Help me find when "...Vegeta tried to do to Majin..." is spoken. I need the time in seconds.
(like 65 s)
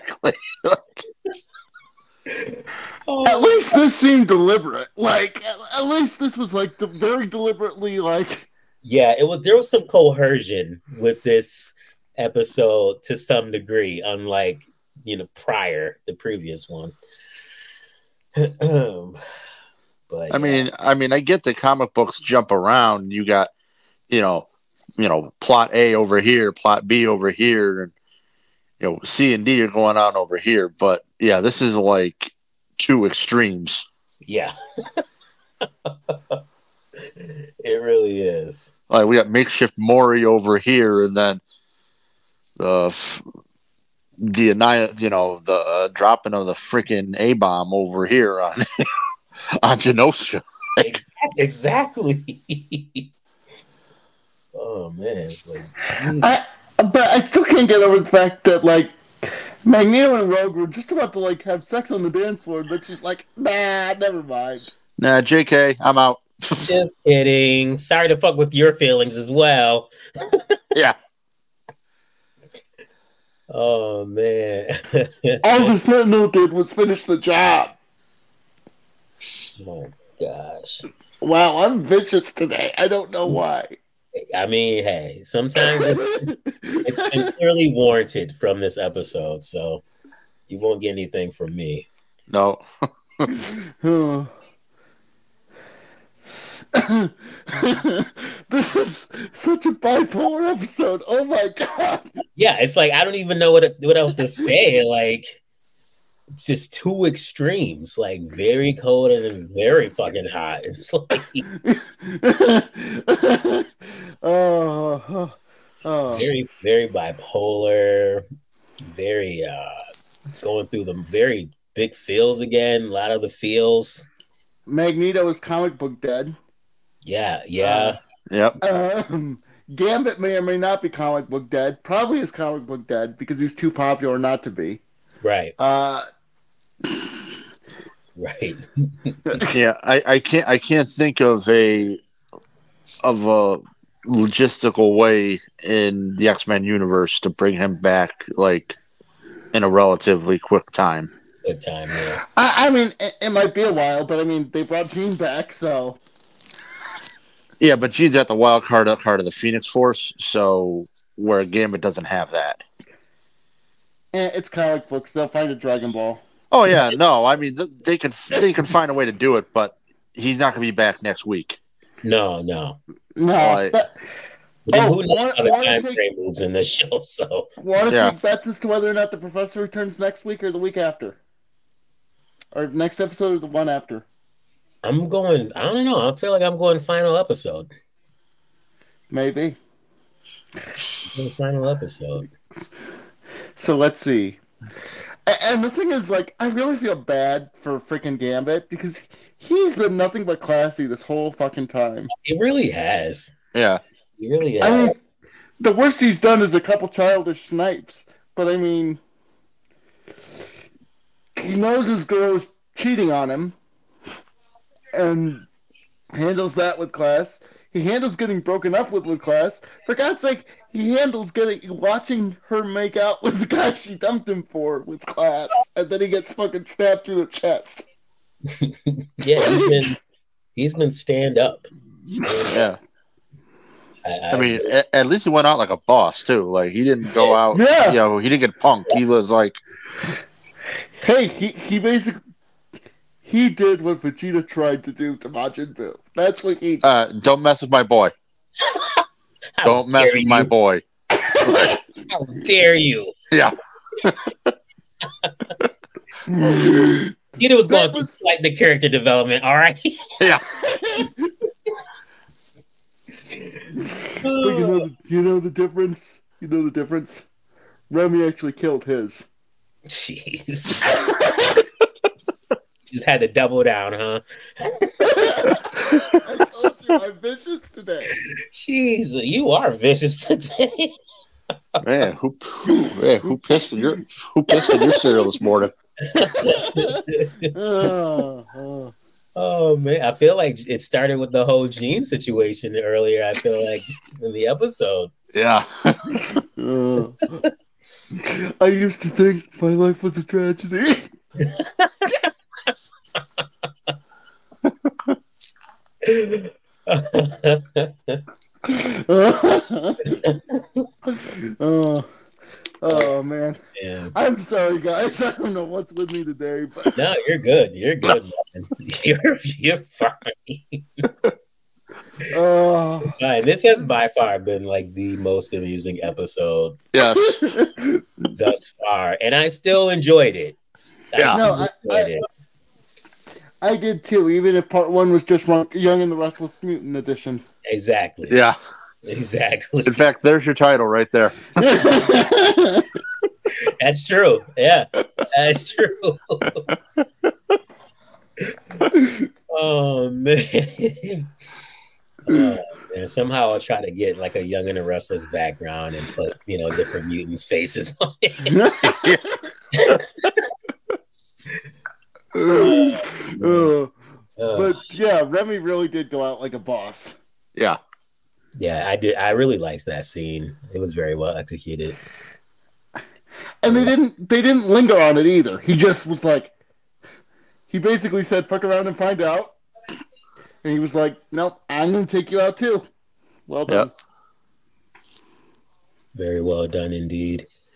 243 s.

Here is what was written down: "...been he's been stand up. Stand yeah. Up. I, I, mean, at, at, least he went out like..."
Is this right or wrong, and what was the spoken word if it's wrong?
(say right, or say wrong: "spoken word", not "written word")
right.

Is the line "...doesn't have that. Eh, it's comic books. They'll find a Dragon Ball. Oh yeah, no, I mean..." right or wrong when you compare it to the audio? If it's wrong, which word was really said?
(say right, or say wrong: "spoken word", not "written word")
right.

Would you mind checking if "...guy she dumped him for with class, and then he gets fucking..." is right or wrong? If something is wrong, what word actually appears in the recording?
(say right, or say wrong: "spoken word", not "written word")
right.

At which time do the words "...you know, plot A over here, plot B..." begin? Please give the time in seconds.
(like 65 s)
24 s.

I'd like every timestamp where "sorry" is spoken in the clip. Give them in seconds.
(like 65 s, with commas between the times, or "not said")
67 s, 314 s.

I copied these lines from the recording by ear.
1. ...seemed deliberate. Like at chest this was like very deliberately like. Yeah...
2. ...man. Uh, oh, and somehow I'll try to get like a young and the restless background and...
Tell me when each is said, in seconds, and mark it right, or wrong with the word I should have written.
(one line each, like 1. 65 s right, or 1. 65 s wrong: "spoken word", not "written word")
1. 3 s wrong: "least", not "chest"
2. 350 s right.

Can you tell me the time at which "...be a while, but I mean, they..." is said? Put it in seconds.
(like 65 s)
153 s.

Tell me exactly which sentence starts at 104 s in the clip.
Like it's just two extremes, like very cold and very fucking hot.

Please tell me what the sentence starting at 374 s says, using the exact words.
They didn't linger on it either.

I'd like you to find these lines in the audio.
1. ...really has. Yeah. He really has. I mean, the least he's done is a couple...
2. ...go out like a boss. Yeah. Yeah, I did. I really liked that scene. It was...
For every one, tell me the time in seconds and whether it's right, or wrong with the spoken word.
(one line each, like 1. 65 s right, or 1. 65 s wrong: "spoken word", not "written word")
1. 202 s wrong: "worst", not "least"
2. 366 s right.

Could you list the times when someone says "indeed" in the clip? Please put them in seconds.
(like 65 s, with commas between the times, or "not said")
386 s.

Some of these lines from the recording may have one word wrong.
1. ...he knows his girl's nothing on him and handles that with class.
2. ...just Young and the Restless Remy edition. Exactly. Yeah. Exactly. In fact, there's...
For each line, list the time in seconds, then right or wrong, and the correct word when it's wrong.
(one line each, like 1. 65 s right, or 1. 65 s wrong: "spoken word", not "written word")
1. 211 s wrong: "cheating", not "nothing"
2. 335 s wrong: "Mutant", not "Remy".